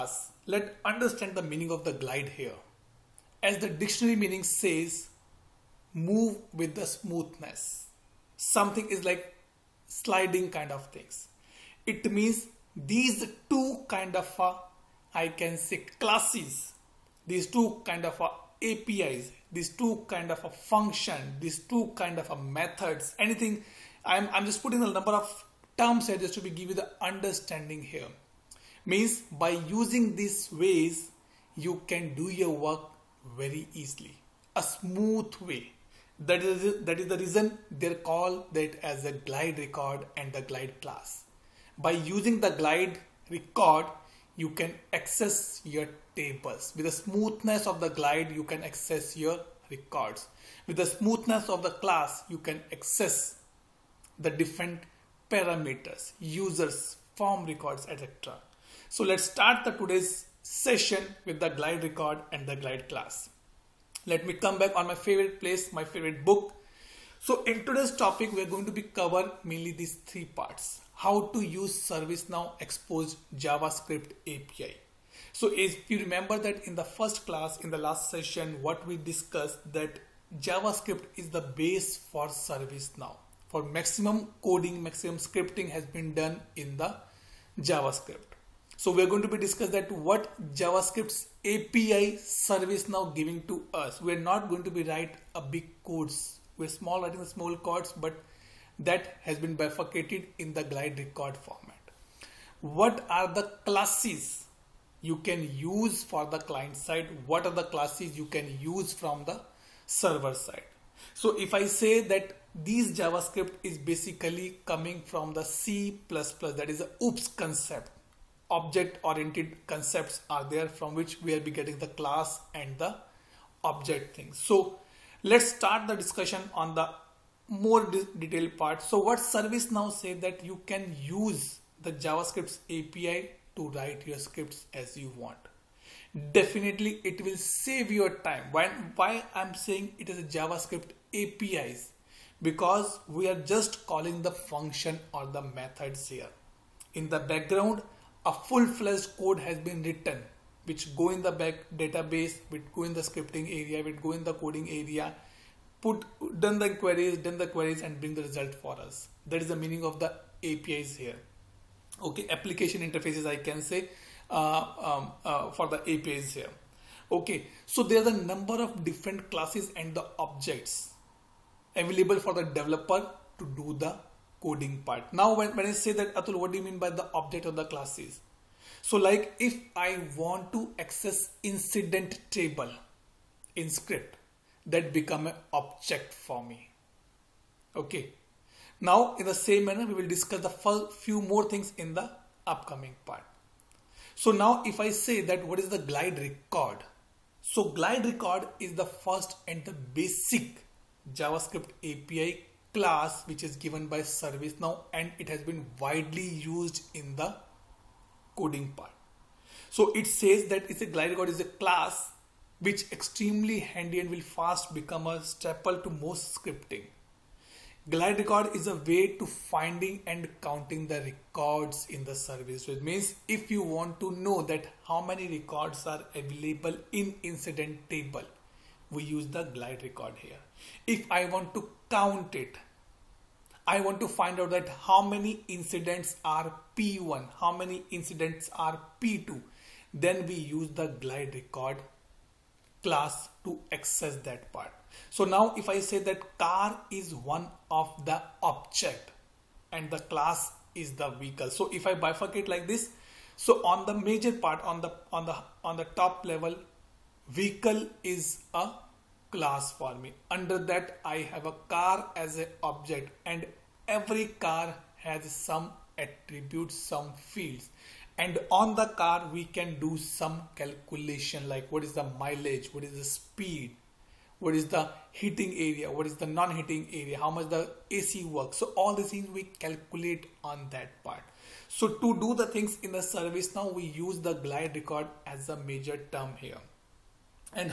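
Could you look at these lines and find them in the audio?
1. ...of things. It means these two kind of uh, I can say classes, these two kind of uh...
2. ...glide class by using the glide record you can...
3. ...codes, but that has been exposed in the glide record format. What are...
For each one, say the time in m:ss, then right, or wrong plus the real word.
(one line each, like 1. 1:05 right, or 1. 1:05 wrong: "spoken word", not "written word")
1. 0:10 right
2. 0:40 right
3. 1:37 wrong: "bifurcated", not "exposed".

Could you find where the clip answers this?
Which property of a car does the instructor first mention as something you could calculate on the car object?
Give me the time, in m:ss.
4:32.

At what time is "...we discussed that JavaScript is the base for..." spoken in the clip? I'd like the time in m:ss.
1:18.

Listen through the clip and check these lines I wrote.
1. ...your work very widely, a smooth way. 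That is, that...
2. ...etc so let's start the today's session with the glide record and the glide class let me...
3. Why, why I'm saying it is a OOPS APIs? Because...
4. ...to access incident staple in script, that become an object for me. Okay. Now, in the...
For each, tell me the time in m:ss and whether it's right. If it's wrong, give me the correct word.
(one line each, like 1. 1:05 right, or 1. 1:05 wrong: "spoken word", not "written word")
1. 0:32 wrong: "easily", not "widely"
2. 0:57 right
3. 2:18 wrong: "JavaScript", not "OOPS"
4. 3:00 wrong: "table", not "staple".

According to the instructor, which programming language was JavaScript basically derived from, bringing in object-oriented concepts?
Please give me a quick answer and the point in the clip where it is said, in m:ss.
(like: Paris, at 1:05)
C++, at 1:55.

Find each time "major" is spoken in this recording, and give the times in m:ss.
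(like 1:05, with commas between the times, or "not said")
4:13, 4:45.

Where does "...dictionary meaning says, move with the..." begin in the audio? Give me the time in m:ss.
0:03.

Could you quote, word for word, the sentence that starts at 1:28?
So we're going to be discuss that what JavaScript's API service now giving to us.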